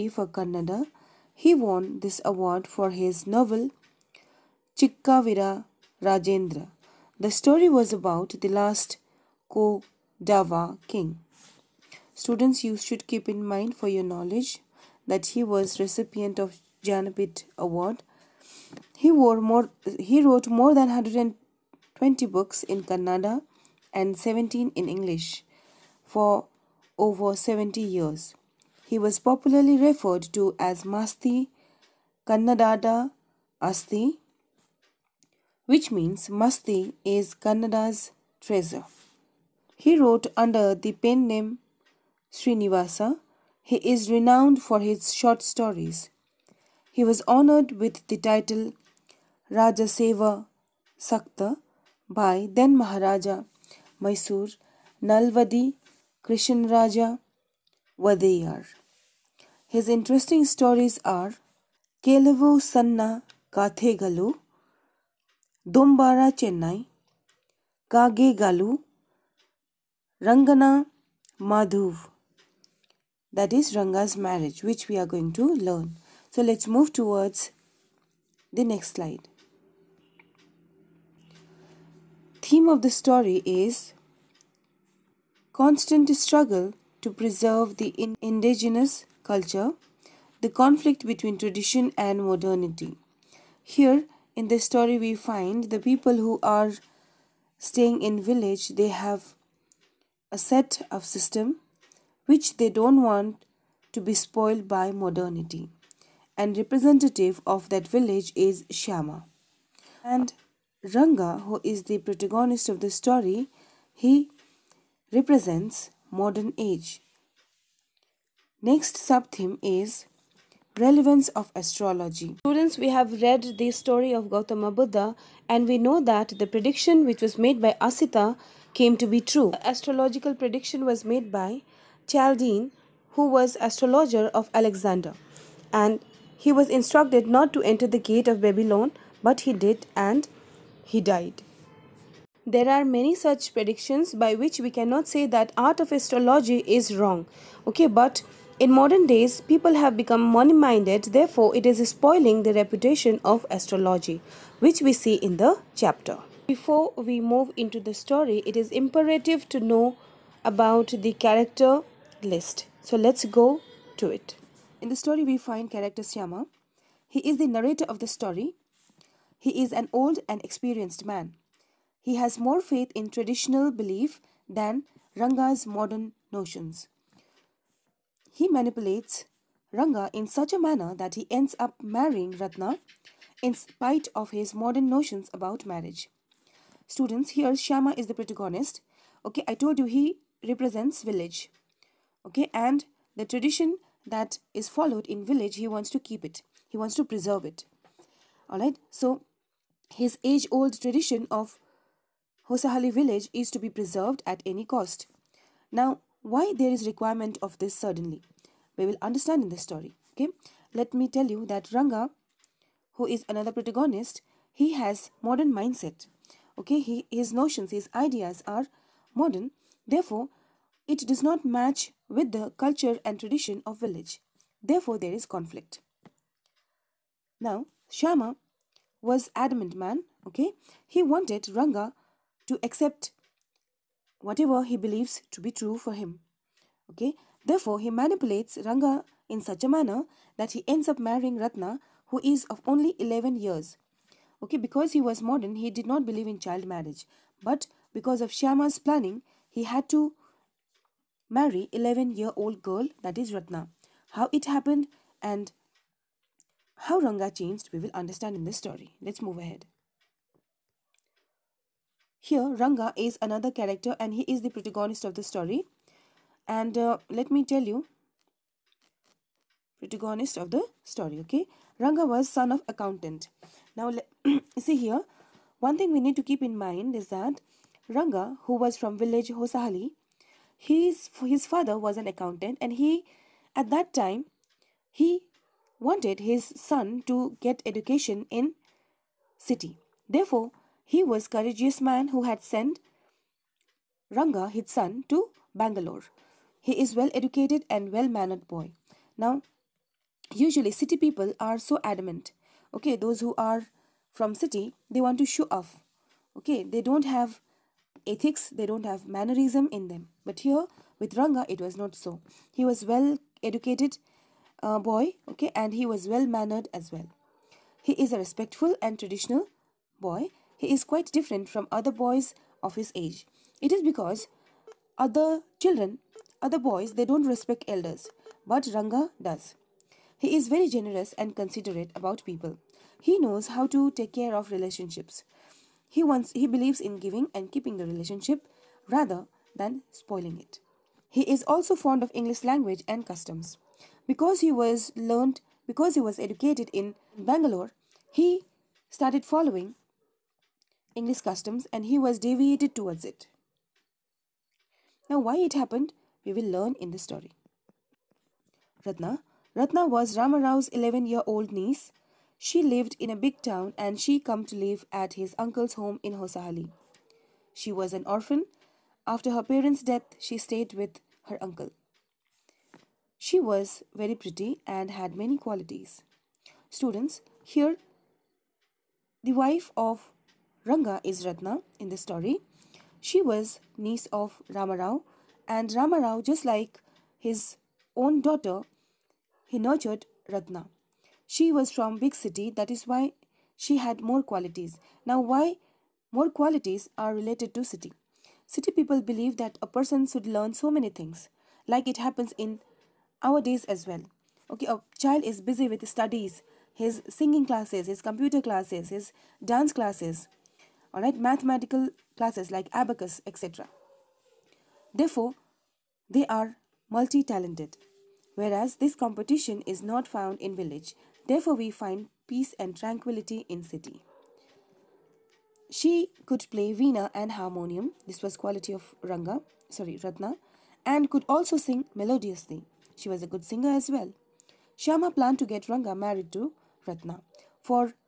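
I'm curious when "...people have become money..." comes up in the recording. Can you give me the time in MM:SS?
02:29.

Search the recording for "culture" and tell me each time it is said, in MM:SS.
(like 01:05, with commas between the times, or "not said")
01:29, 03:42.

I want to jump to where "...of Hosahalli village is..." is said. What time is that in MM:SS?
03:21.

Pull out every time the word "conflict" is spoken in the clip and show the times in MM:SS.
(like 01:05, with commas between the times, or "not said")
01:30, 03:45.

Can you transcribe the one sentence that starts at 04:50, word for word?
Therefore, he was courageous man who had sent Ranga, his son, to Bangalore.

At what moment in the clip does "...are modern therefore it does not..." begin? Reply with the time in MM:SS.
03:38.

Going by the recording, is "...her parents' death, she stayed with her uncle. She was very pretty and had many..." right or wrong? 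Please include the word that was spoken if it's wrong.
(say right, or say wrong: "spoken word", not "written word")
right.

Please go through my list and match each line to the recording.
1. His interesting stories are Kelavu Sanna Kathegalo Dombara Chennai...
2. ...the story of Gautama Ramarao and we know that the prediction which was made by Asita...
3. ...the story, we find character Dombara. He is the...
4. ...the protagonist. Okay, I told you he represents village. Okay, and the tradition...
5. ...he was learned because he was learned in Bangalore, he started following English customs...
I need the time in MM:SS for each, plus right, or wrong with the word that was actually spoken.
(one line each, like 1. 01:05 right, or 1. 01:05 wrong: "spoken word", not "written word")
1. 00:59 right
2. 02:03 wrong: "Buddha", not "Ramarao"
3. 02:44 wrong: "Shyama", not "Dombara"
4. 03:08 right
5. 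05:44 wrong: "educated", not "learned".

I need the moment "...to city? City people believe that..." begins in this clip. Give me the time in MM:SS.
06:37.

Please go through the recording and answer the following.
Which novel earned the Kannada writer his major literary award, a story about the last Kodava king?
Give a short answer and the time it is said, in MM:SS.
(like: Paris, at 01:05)
Chikkavira Rajendra, at 00:04.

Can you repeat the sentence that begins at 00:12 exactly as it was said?
Students, you should keep in mind for your knowledge that he was recipient of Jnanpith Award.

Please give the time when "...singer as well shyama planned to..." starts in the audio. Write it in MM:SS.
07:13.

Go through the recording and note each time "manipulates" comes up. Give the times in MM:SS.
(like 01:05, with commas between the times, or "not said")
02:58, 03:57.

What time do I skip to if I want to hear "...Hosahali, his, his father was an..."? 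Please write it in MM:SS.
04:39.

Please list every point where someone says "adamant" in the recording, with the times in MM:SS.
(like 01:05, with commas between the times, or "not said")
03:49, 05:01.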